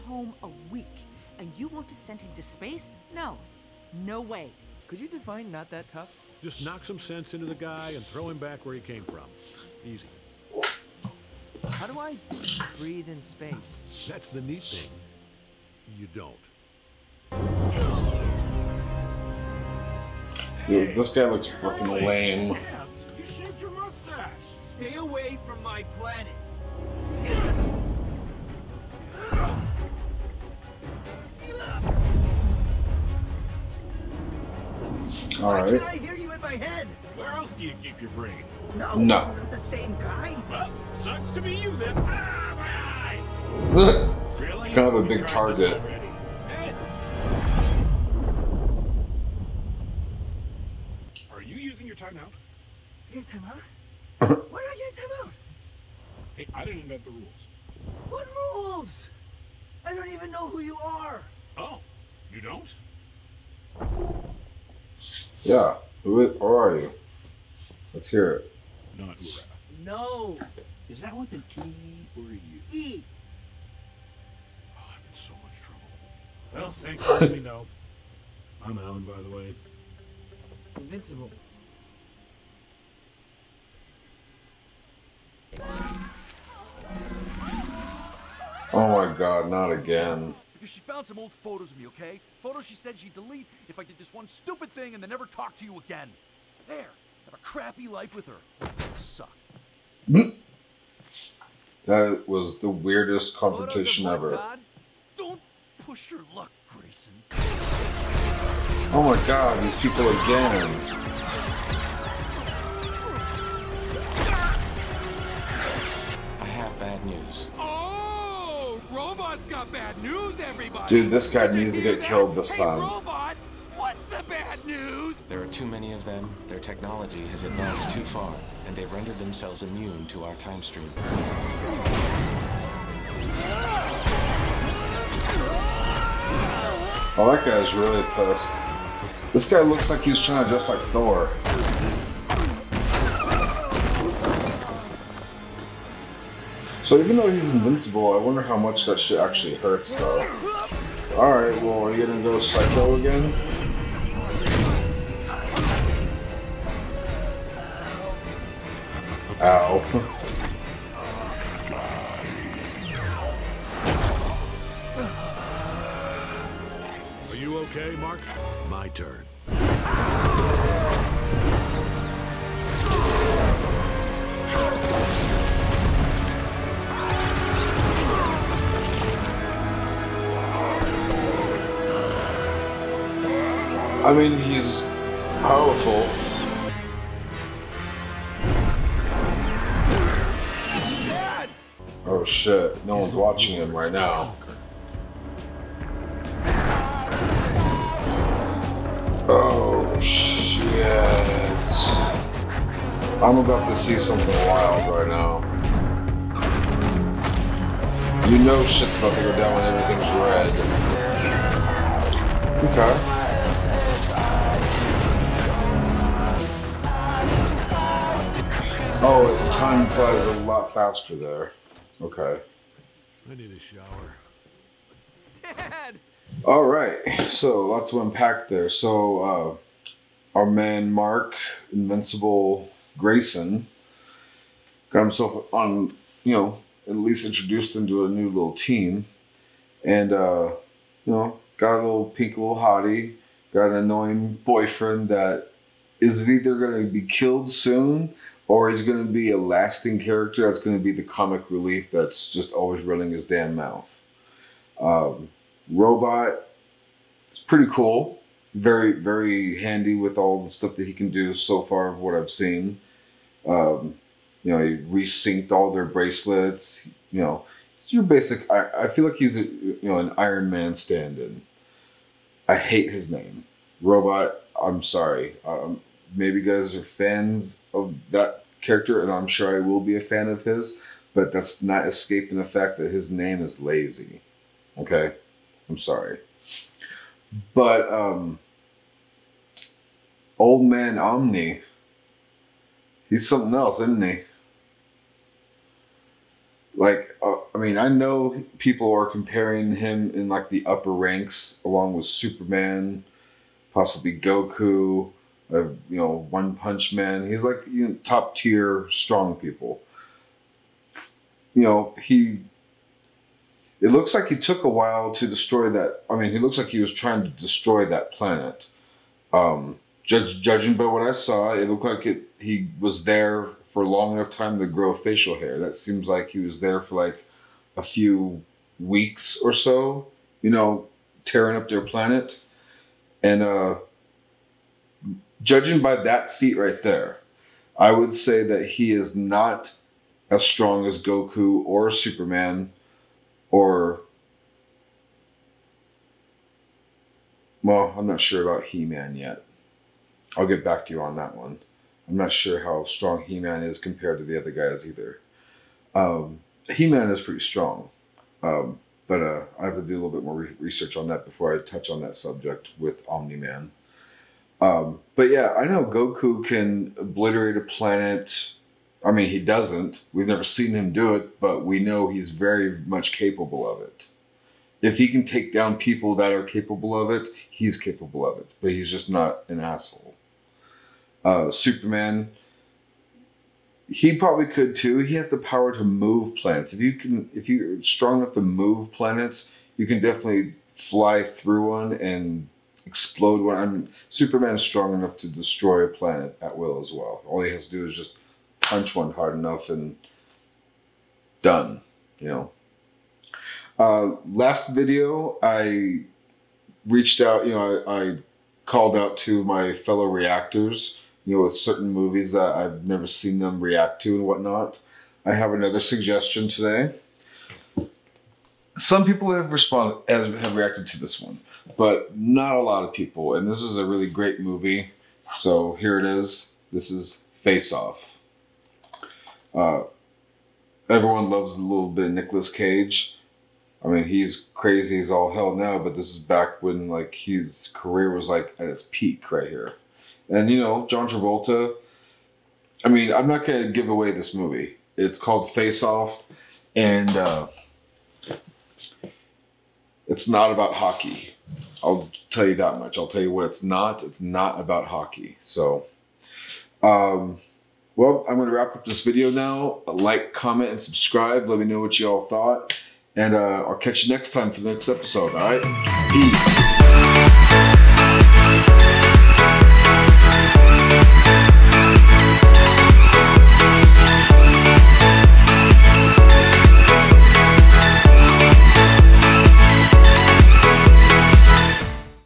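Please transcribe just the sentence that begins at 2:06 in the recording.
Their technology has advanced too far, and they've rendered themselves immune to our time stream.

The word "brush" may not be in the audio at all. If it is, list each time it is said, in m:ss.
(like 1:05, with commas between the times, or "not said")
not said.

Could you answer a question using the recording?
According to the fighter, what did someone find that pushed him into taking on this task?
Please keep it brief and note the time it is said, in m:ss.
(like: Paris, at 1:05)
Old photos, at 1:31.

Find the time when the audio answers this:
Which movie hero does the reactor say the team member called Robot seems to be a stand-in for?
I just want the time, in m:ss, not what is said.
4:30.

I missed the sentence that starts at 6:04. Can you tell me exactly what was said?
Um, but yeah, I know Goku can obliterate a planet.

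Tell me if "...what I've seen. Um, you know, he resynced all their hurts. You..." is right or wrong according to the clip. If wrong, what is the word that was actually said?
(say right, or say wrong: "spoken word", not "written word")
wrong: "bracelets", not "hurts".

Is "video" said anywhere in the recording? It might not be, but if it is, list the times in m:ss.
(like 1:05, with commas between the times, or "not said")
6:44, 7:39.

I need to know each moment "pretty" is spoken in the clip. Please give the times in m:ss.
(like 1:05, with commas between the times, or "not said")
4:17, 5:57.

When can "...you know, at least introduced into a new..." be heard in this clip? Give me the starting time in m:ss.
3:56.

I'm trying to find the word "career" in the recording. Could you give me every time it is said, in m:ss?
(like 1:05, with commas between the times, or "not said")
7:17.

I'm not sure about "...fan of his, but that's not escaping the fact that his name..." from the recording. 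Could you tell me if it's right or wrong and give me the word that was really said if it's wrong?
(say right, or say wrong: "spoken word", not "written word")
right.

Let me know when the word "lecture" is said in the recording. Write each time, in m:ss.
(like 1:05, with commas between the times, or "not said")
not said.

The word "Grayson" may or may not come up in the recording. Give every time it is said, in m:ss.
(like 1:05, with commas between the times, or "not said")
1:46, 3:52.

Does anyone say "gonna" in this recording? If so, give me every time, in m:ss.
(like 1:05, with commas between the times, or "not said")
2:32, 7:23.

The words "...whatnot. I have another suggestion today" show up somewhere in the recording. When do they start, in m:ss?
6:54.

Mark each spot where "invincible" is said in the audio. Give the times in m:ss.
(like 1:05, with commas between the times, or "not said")
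1:20, 2:27, 3:51.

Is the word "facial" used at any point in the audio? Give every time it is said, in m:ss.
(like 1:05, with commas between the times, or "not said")
5:24.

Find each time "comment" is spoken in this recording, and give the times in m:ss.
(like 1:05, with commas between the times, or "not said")
7:40.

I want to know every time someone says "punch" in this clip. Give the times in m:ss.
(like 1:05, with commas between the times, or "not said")
5:06, 6:38.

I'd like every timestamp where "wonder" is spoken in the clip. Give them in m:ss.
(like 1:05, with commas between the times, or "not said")
2:28.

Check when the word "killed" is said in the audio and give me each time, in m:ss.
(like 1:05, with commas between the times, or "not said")
2:02, 4:07.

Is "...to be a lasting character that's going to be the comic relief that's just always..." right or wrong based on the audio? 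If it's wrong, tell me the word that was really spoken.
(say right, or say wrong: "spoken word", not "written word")
right.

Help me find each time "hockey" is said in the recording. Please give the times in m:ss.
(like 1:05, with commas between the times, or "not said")
7:30, 7:34.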